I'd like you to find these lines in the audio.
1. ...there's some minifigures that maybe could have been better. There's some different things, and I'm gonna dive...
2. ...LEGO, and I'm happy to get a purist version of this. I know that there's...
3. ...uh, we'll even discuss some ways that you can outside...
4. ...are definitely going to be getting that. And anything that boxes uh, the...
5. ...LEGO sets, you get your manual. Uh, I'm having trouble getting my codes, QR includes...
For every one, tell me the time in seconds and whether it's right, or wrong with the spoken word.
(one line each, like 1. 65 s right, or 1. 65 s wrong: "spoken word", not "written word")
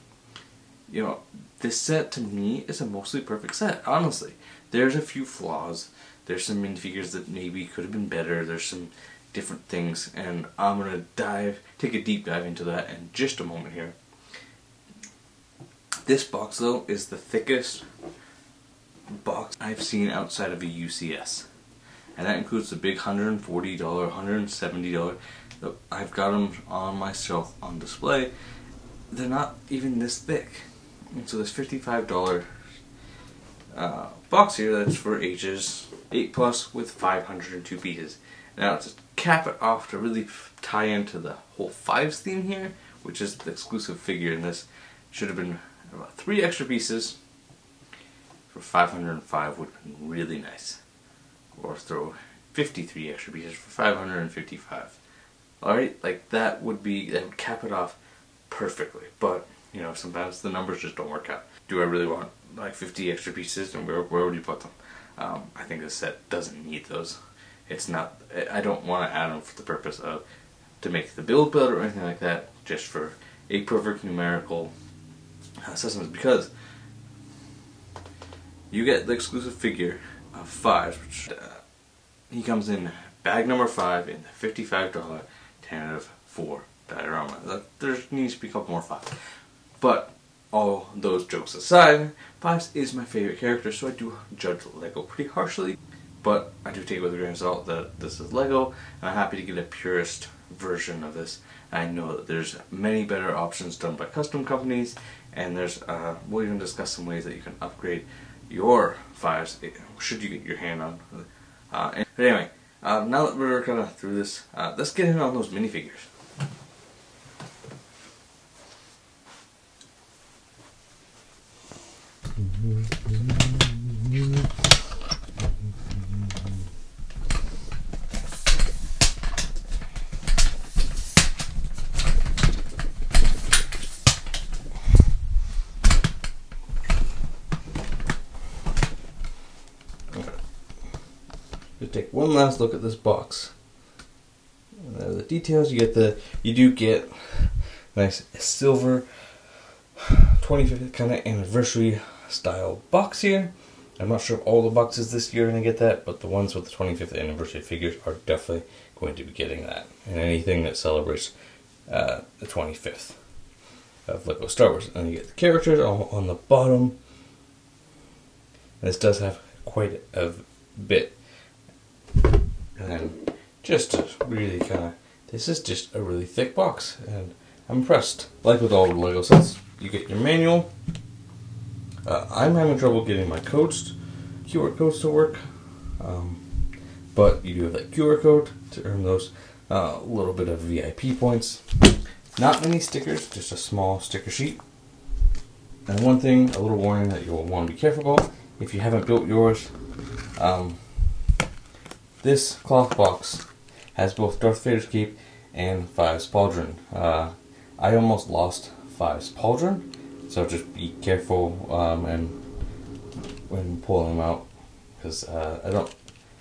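1. 6 s right
2. 98 s right
3. 105 s wrong: "upgrade", not "outside"
4. 158 s wrong: "celebrates", not "boxes"
5. 178 s wrong: "codes", not "includes".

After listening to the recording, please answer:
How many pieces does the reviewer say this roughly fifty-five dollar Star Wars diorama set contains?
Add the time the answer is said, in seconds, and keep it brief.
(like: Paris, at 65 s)
502, at 36 s.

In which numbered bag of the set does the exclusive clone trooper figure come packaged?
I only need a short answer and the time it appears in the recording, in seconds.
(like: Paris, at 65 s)
Bag 5, at 83 s.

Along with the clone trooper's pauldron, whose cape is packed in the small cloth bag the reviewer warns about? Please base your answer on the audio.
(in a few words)
Darth Vader.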